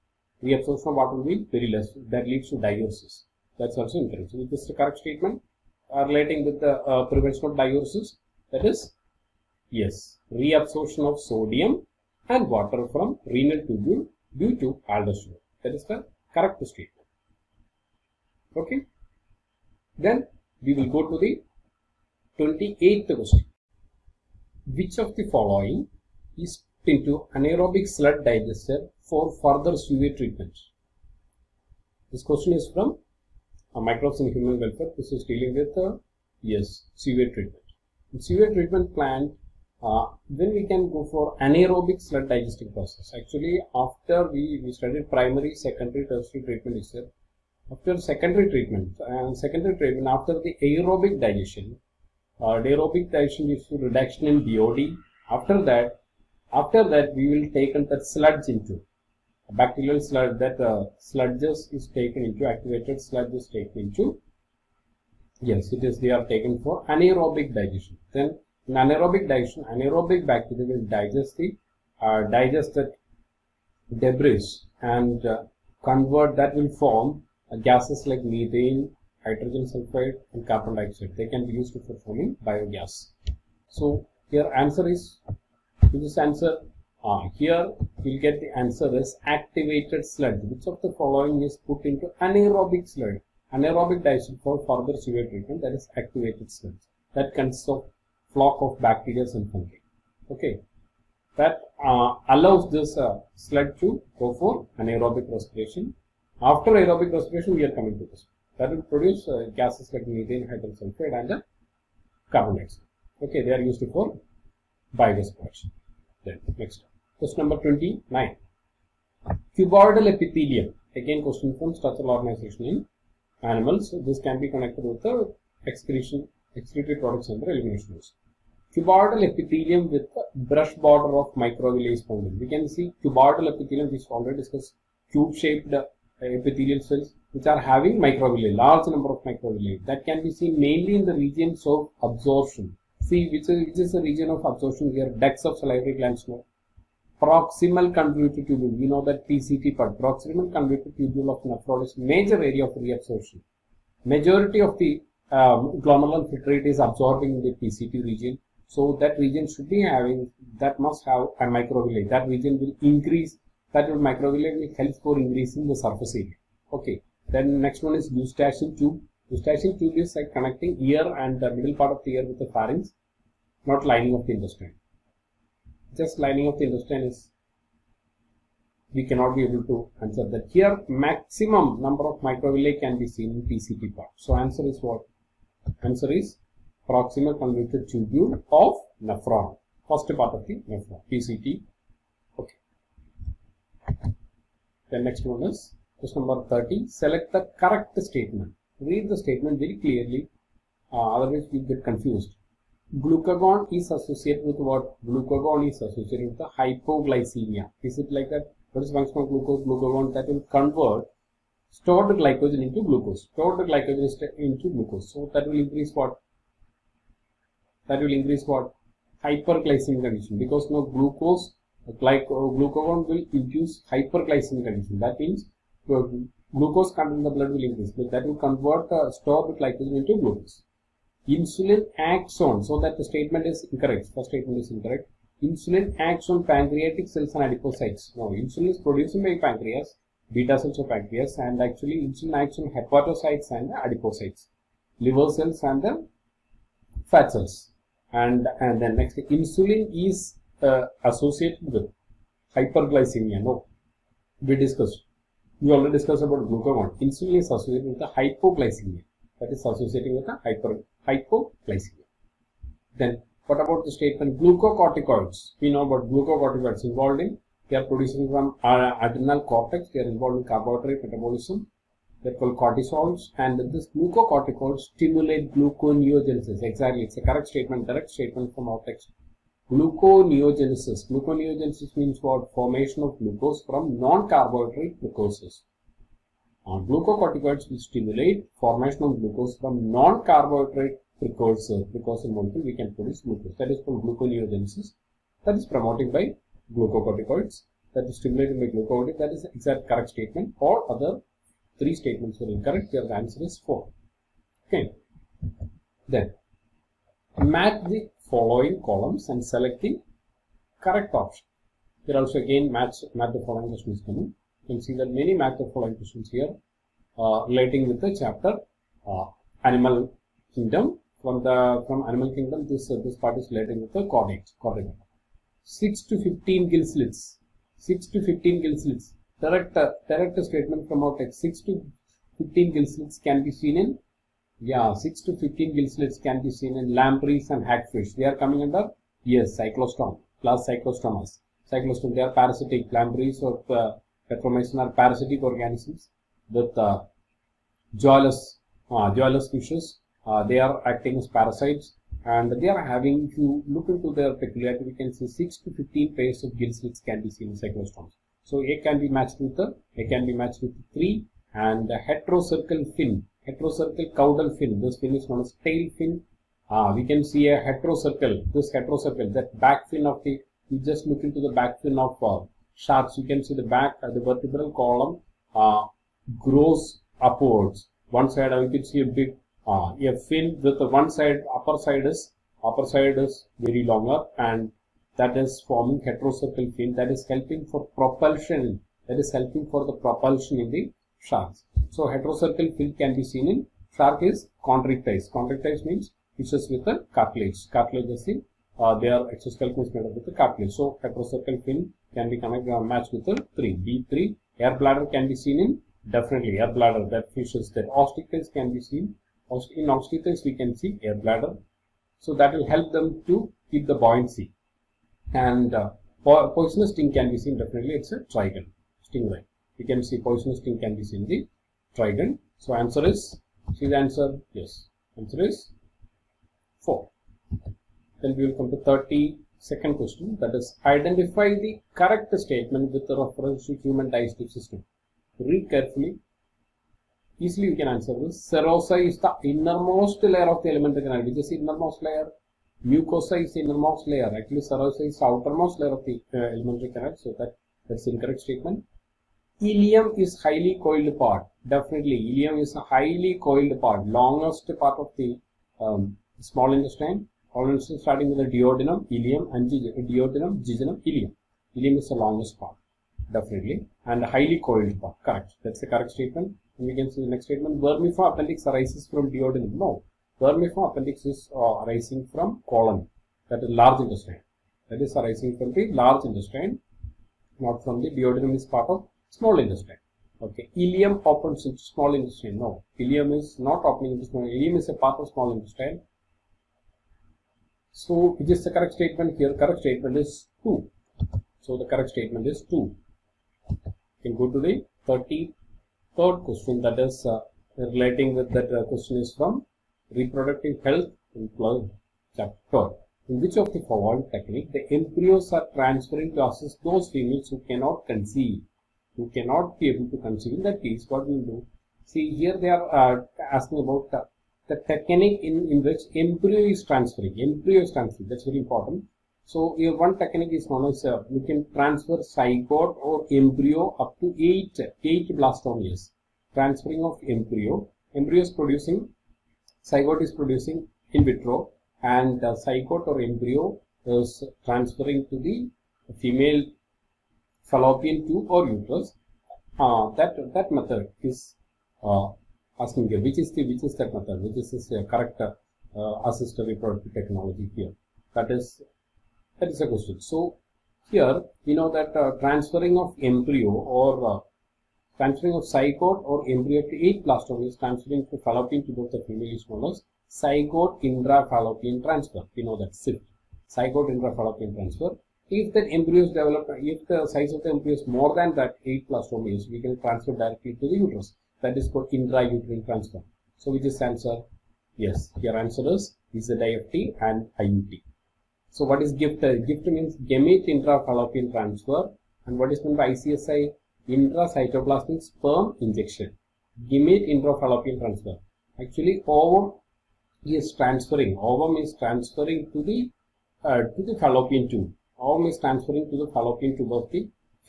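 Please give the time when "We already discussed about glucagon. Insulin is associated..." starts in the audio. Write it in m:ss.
4:15.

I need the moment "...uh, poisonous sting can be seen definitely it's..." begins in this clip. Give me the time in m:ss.
6:55.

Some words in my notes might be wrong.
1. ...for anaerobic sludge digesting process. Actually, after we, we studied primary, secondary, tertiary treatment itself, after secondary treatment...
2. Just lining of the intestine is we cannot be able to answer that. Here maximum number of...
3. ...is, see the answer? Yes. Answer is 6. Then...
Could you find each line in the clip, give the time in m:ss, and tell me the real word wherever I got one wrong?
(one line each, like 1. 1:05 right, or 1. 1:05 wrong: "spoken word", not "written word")
1. 0:41 right
2. 2:55 right
3. 7:03 wrong: "4", not "6".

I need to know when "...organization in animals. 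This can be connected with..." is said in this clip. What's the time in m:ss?
2:02.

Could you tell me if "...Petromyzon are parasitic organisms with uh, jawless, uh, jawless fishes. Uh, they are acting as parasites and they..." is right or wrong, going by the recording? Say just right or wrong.
right.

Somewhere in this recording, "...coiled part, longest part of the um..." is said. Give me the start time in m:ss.
7:33.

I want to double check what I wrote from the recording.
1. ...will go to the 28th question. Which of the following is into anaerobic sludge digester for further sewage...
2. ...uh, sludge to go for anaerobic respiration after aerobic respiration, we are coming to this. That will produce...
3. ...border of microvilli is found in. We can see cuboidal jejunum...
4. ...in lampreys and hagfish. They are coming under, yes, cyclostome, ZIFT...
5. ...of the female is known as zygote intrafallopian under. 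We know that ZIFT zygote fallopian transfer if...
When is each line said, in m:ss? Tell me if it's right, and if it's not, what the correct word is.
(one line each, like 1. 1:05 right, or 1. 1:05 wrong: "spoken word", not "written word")
1. 0:20 right
2. 1:42 right
3. 2:10 wrong: "epithelium", not "jejunum"
4. 5:36 wrong: "Plus", not "ZIFT"
5. 9:19 wrong: "transfer", not "under".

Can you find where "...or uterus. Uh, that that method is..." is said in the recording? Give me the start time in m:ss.
8:58.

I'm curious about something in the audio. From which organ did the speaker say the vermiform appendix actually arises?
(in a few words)
Colon.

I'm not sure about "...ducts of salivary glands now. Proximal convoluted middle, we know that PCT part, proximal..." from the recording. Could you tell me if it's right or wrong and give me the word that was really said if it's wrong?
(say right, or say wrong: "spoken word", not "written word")
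wrong: "tubule", not "middle".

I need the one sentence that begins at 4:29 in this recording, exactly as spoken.
They are involved in carbohydrate metabolism.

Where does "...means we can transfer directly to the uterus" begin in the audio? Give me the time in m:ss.
9:29.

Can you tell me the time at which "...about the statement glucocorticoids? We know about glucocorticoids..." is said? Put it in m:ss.
4:23.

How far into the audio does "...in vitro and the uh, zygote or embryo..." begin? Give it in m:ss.
8:51.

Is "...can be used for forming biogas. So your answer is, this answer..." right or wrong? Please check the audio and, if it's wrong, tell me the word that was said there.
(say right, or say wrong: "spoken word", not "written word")
right.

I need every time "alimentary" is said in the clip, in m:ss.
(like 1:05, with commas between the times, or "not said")
7:20, 7:26.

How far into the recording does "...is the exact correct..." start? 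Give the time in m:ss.
4:59.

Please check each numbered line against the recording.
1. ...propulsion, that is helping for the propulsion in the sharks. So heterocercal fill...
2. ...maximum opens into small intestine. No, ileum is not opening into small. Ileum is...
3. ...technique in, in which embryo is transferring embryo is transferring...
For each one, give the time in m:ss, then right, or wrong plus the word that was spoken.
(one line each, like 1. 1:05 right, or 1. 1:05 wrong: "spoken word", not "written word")
1. 6:27 right
2. 8:00 wrong: "ileum", not "maximum"
3. 8:34 right.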